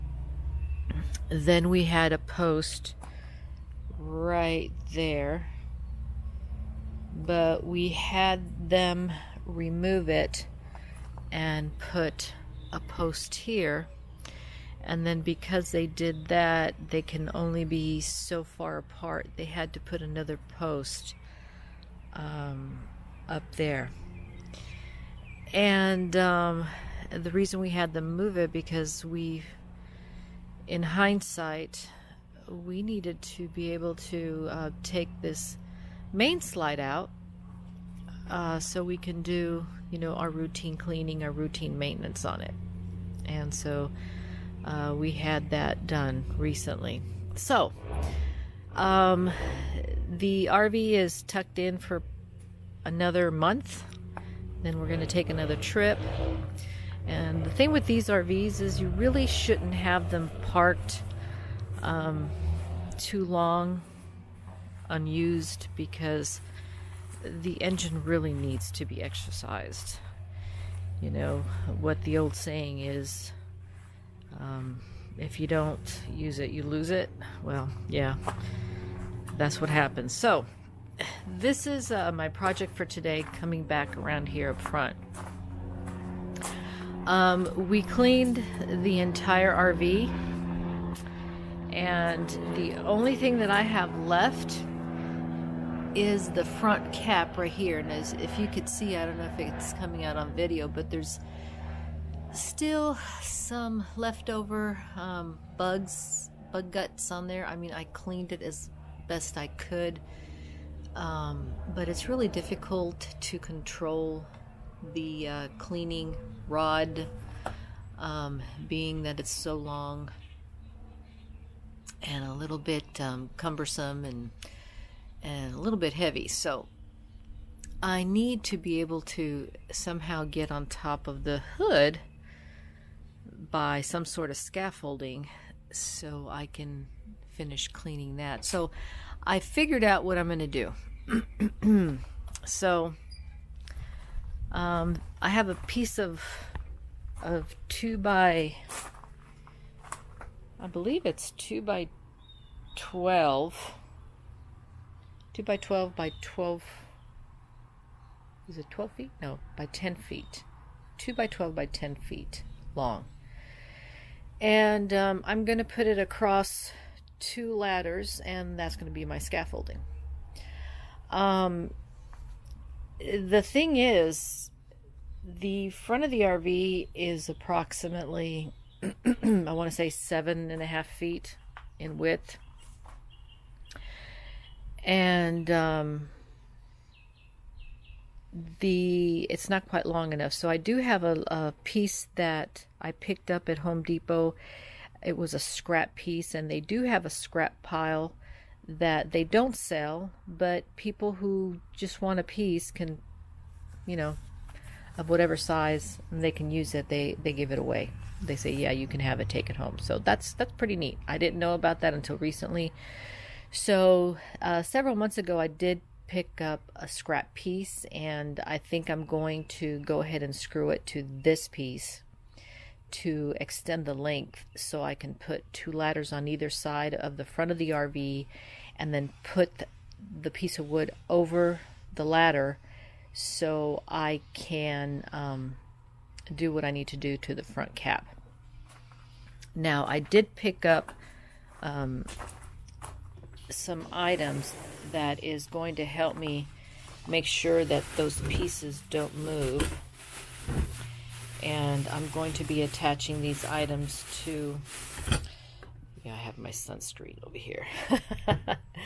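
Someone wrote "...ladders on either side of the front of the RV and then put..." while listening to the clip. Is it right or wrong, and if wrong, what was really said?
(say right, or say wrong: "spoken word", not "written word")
right.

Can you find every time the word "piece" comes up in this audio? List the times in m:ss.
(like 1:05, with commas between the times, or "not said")
2:25, 3:11, 3:15, 3:22, 3:37, 3:41, 3:50, 4:08.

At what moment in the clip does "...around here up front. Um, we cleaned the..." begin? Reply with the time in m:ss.
1:23.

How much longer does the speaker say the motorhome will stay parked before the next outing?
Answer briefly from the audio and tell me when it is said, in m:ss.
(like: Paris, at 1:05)
another month, at 0:52.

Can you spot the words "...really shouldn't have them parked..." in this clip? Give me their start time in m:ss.
0:58.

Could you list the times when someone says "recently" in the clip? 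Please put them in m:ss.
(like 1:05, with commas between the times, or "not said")
0:46, 3:32.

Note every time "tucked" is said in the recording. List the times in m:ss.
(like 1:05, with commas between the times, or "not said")
0:51.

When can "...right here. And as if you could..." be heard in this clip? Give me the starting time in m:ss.
1:37.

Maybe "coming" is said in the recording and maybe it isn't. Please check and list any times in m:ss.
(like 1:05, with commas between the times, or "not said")
1:23, 1:39.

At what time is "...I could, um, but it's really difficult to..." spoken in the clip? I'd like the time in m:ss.
1:49.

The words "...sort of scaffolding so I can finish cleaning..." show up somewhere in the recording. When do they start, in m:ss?
2:14.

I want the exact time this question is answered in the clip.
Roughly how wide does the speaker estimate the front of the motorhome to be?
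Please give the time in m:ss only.
2:59.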